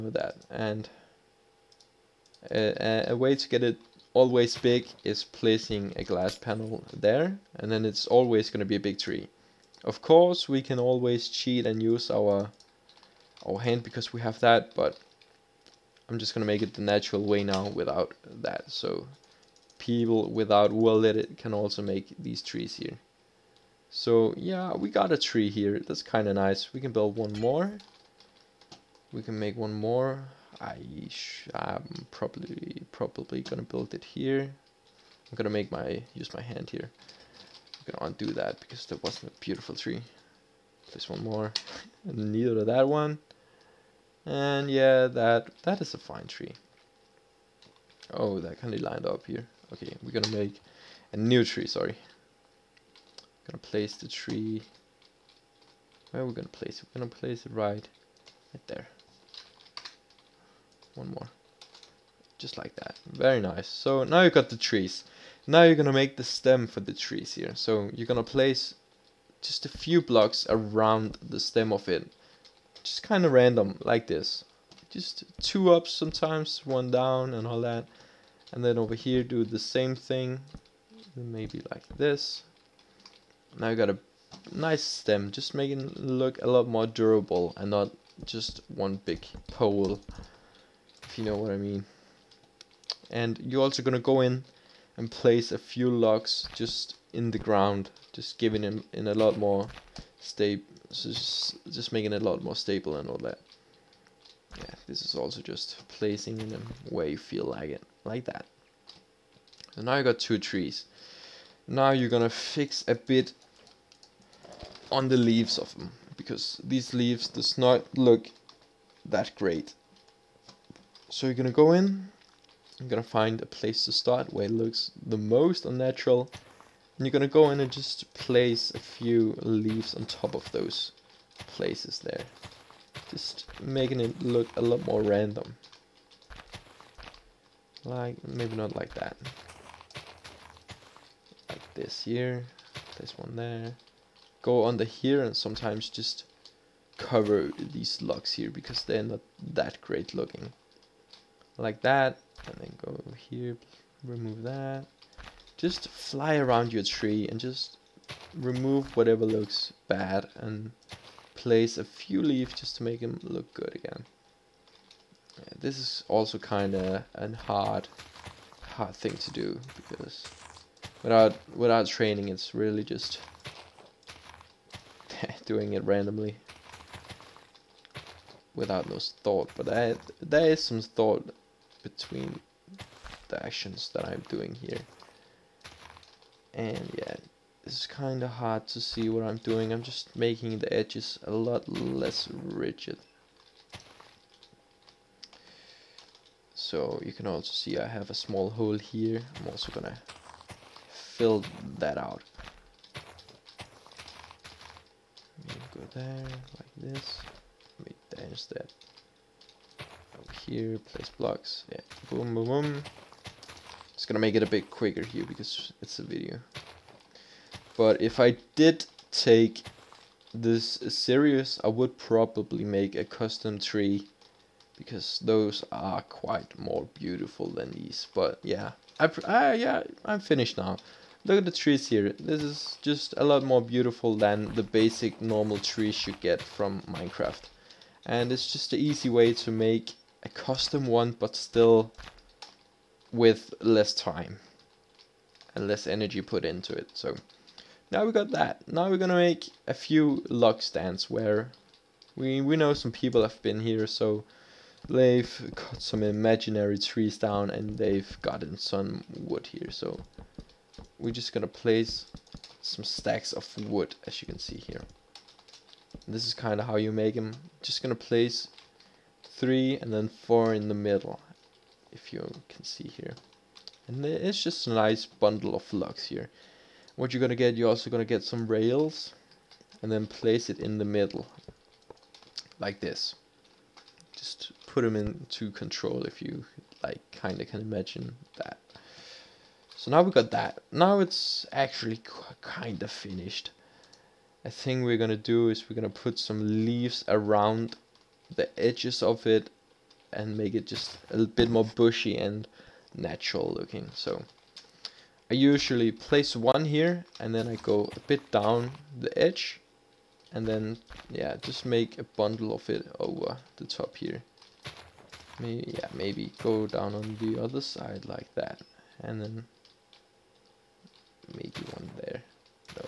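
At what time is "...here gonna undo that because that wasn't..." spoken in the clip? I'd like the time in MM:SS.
00:36.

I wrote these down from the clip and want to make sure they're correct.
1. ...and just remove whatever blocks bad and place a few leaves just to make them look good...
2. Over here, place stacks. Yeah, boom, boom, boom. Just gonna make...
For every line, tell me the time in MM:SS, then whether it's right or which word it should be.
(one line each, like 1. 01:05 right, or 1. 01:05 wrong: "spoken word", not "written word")
1. 02:37 wrong: "looks", not "blocks"
2. 03:30 wrong: "blocks", not "stacks".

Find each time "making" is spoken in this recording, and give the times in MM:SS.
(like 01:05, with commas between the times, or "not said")
01:25, 01:41, 02:13, 03:10.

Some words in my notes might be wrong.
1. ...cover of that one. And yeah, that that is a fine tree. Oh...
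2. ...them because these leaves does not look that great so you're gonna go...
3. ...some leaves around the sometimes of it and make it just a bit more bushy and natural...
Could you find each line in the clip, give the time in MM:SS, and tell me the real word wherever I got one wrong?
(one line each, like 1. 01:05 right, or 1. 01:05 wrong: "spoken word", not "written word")
1. 00:42 wrong: "neither", not "cover"
2. 01:55 right
3. 04:56 wrong: "edges", not "sometimes".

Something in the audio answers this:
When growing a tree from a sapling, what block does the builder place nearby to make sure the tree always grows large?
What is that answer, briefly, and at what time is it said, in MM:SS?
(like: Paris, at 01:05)
glass panel, at 00:06.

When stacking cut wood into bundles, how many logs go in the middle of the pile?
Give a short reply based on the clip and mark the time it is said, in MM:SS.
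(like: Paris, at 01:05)
4, at 04:30.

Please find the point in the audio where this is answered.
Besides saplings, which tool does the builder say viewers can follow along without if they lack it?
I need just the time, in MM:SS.
00:20.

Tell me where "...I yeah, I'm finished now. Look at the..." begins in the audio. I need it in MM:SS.
03:49.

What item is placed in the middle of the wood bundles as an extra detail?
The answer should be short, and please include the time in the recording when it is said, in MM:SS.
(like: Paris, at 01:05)
rails, at 04:38.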